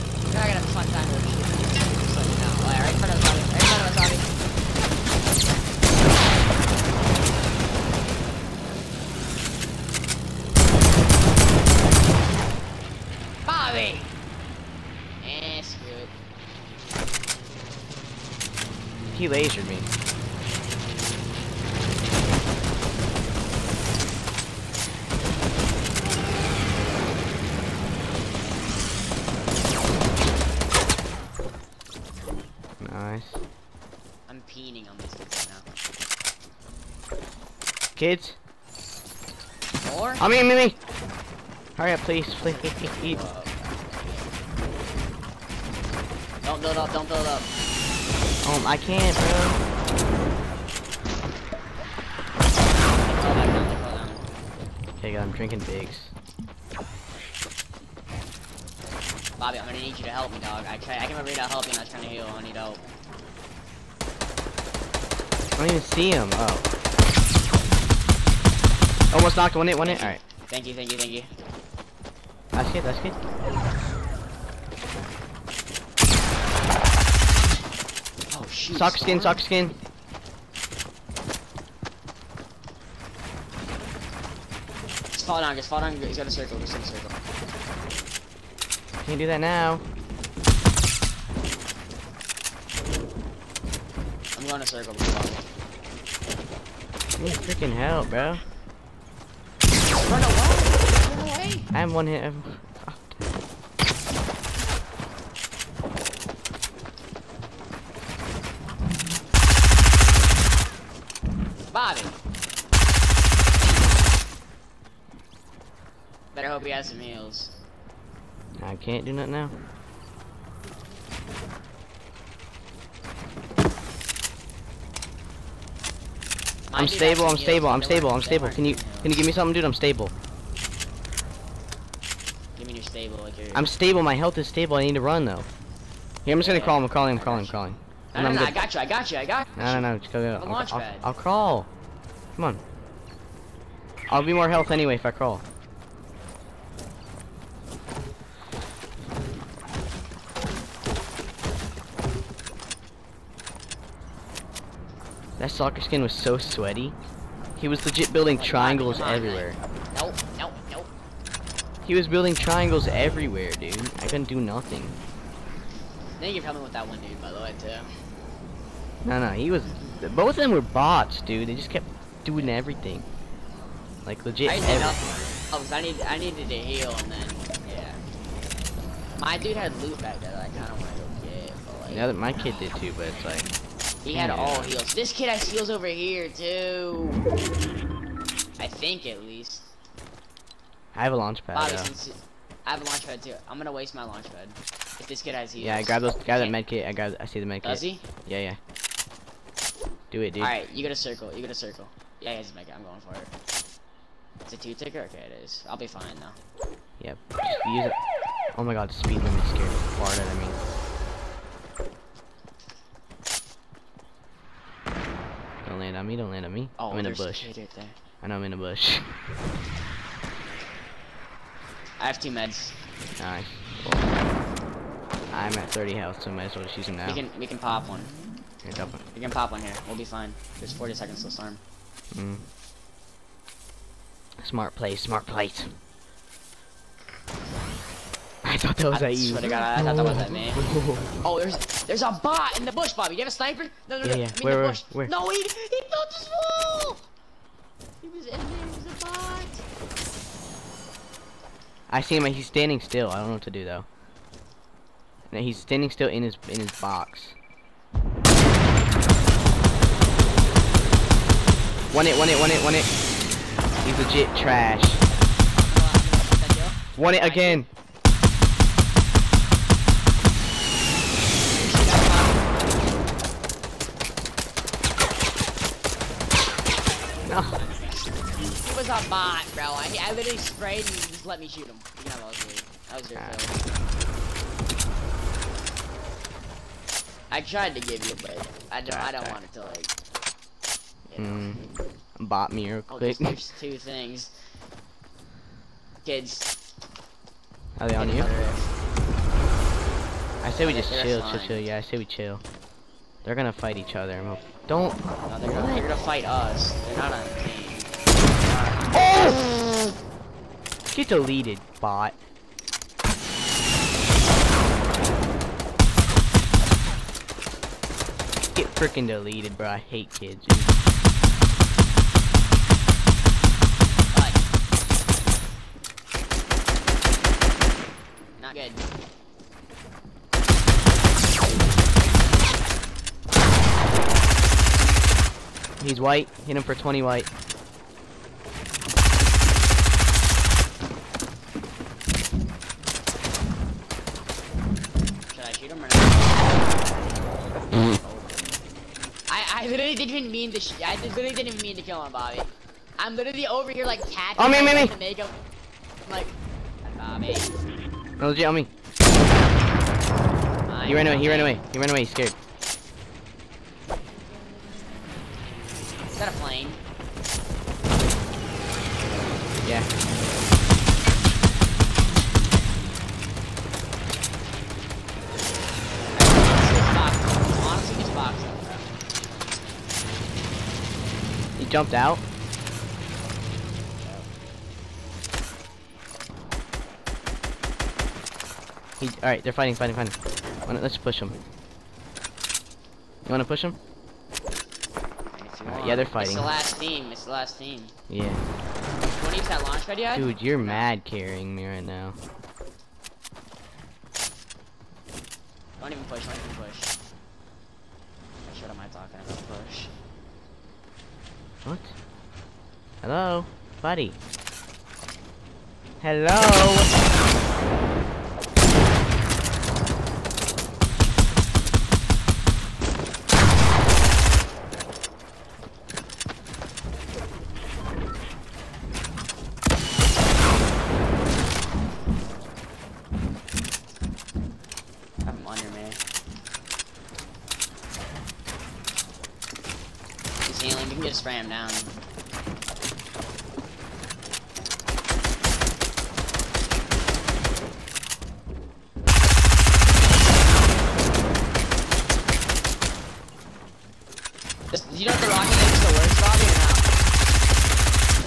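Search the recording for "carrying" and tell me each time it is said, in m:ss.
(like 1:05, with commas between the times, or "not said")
6:41.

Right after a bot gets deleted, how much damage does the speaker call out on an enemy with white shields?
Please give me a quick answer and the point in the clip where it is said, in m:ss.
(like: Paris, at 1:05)
20, at 5:36.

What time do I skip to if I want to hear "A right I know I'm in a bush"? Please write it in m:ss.
3:37.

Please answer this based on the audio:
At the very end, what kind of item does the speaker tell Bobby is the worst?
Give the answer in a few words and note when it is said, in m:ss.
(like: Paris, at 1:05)
the rocket thing, at 7:35.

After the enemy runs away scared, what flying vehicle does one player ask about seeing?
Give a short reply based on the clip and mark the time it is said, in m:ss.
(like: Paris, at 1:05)
a plane, at 6:06.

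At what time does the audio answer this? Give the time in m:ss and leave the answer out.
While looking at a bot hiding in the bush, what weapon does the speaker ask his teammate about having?
4:03.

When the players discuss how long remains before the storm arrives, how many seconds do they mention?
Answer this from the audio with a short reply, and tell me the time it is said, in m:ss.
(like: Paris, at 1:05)
40, at 3:50.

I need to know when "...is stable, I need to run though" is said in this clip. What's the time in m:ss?
2:14.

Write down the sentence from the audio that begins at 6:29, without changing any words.
He, alright, they're fighting, fighting, fighting.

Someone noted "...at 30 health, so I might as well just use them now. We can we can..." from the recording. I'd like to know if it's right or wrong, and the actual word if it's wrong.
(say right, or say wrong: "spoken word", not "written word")
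right.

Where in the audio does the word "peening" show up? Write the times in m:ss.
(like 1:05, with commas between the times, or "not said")
0:34.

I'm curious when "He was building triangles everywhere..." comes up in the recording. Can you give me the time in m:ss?
2:41.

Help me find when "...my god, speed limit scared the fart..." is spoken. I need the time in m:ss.
3:28.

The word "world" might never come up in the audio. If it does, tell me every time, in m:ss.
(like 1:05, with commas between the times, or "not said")
not said.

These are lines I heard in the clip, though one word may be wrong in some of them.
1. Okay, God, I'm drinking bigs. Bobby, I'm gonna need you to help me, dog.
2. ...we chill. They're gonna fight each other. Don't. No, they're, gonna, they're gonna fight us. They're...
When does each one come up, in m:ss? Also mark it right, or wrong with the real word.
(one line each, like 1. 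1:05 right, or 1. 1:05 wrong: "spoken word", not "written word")
1. 0:54 right
2. 5:01 right.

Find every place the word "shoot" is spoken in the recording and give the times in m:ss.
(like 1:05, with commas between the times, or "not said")
4:41, 5:45.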